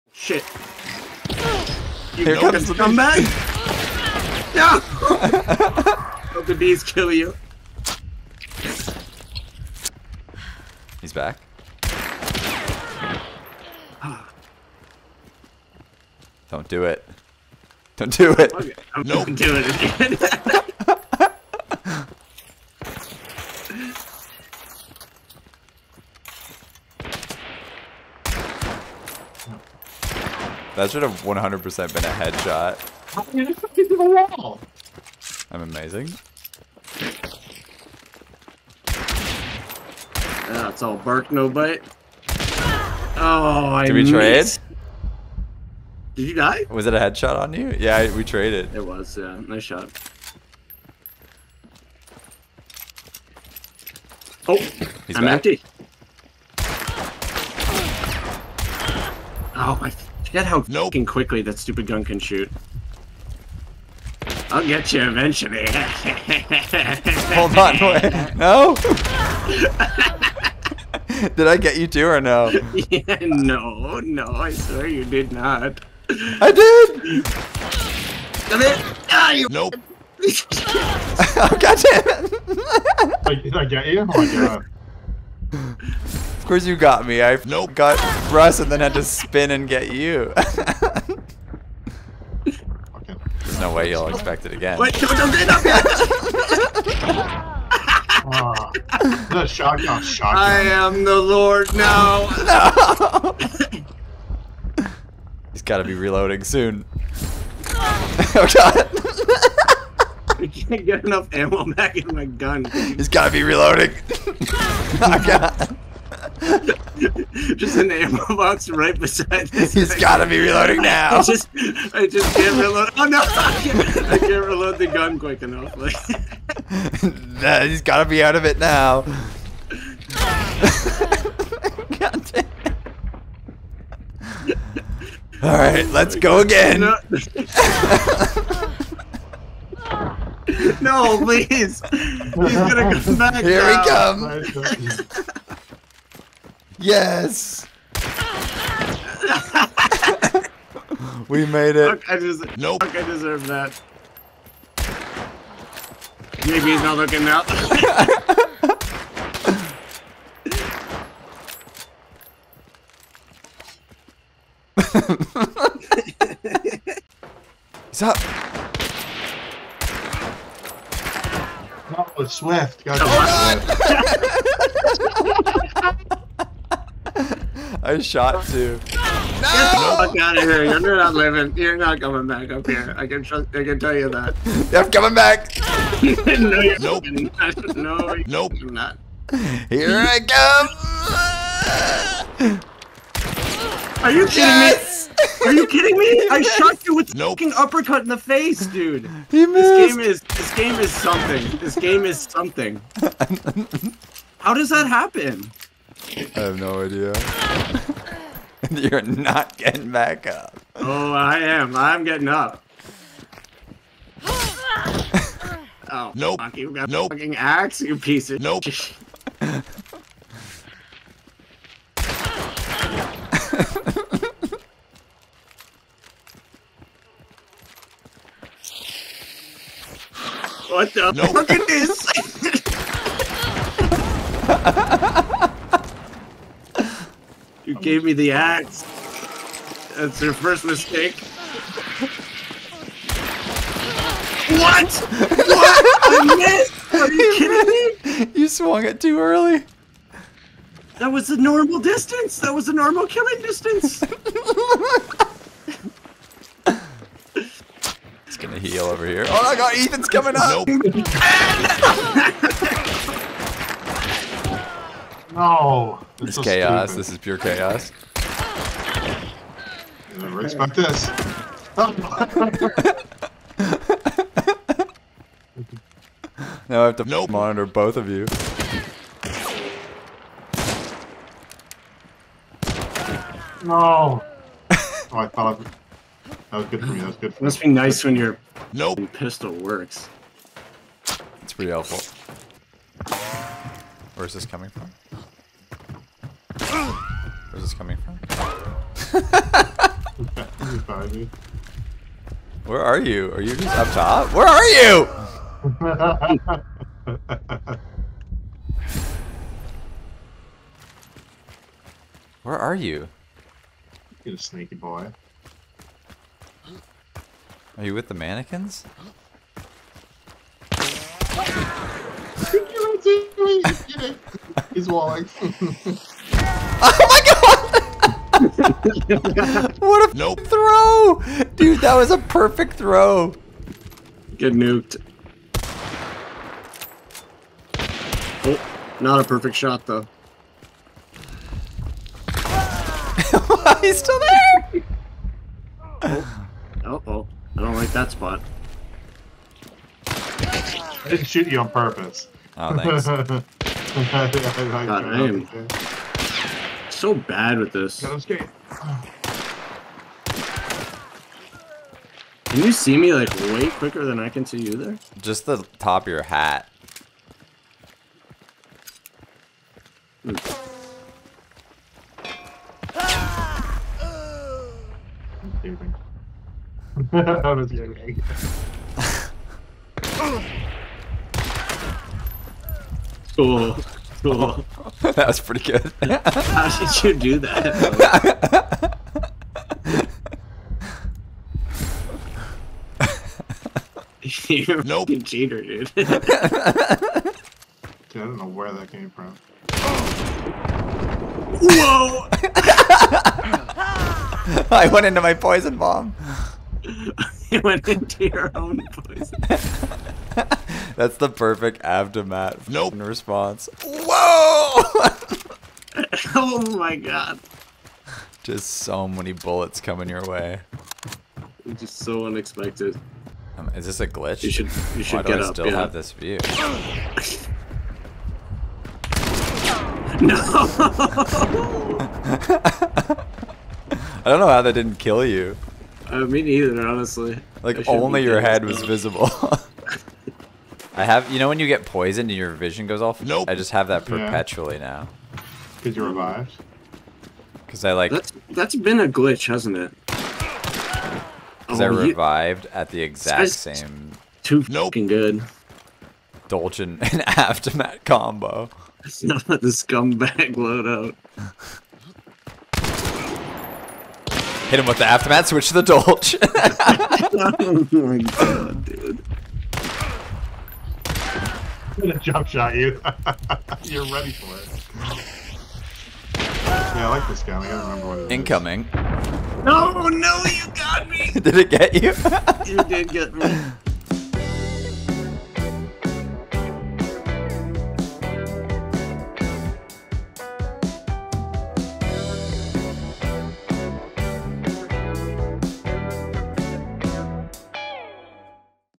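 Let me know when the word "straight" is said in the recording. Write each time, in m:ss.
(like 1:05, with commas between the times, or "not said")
not said.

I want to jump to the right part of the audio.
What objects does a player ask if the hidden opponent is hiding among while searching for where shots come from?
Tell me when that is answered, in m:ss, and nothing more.
5:18.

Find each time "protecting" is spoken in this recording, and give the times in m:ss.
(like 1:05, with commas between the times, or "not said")
not said.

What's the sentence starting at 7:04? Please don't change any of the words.
You should, you should Why get do I up, still yeah.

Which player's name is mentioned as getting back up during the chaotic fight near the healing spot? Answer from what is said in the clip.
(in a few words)
Ethan.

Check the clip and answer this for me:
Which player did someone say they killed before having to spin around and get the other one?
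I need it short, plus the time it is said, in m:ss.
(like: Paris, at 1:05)
Russ, at 1:28.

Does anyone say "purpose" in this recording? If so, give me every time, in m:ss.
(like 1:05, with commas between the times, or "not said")
5:51.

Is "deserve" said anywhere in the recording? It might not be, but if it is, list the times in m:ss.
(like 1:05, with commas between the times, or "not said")
2:33.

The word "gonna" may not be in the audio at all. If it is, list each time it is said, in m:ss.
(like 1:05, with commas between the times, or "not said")
2:22, 4:18, 7:52.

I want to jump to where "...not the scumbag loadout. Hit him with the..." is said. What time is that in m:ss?
7:39.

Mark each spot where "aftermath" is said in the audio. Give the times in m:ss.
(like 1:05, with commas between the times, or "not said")
6:51, 7:37, 7:45.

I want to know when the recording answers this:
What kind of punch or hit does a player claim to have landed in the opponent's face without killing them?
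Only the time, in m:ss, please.
3:17.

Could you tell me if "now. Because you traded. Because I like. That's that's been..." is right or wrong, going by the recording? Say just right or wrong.
wrong.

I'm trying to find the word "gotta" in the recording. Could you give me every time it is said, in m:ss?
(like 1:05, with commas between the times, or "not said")
7:57.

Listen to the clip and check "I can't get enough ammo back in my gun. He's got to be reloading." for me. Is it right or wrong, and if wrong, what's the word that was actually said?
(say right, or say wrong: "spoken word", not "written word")
right.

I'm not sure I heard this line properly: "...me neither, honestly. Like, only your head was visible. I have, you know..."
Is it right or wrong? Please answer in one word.
right.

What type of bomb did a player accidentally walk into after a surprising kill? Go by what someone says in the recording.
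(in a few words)
Poison bomb.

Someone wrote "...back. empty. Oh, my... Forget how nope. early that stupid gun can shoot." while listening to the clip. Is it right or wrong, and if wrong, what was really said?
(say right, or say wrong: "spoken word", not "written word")
wrong: "quickly", not "early".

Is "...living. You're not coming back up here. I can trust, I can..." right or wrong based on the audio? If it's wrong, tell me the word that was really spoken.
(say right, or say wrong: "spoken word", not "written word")
right.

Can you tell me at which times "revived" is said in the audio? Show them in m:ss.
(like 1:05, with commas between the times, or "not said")
7:26, 7:31.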